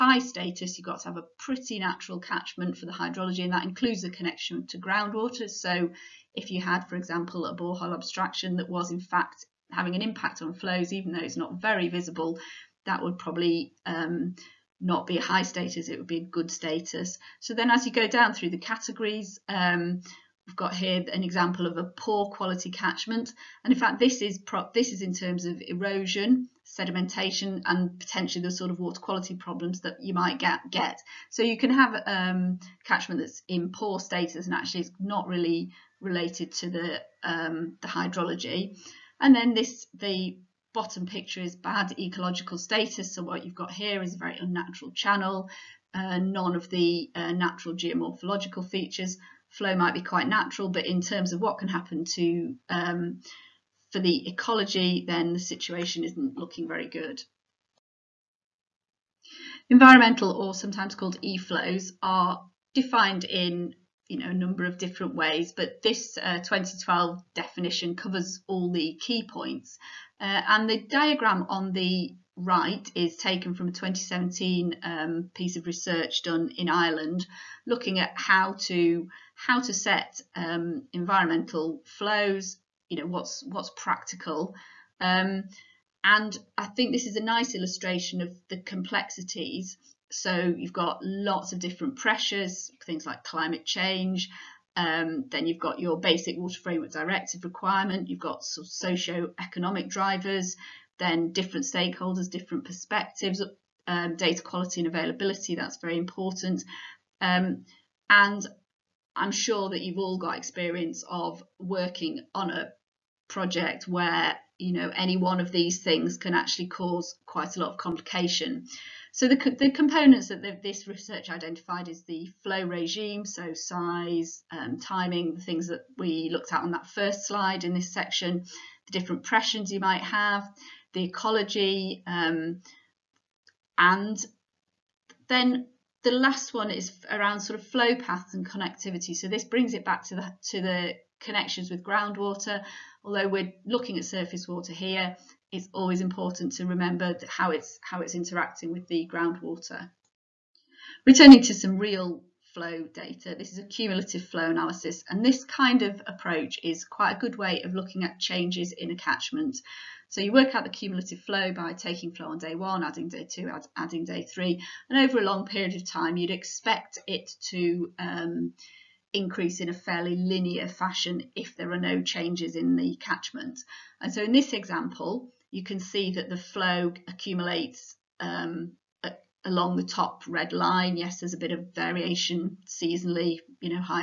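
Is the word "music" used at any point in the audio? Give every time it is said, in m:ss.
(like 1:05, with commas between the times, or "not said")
not said.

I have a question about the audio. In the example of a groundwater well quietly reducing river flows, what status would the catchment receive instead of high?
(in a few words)
Good status.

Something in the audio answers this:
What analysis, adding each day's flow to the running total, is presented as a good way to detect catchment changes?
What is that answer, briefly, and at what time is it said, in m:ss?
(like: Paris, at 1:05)
Cumulative flow analysis, at 2:33.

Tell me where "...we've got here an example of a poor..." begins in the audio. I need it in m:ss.
0:20.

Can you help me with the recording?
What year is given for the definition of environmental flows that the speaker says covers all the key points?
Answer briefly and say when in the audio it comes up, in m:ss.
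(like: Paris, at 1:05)
2012, at 1:06.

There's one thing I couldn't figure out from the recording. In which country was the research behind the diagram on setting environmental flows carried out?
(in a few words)
Ireland.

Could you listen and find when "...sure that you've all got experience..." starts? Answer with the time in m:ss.
1:49.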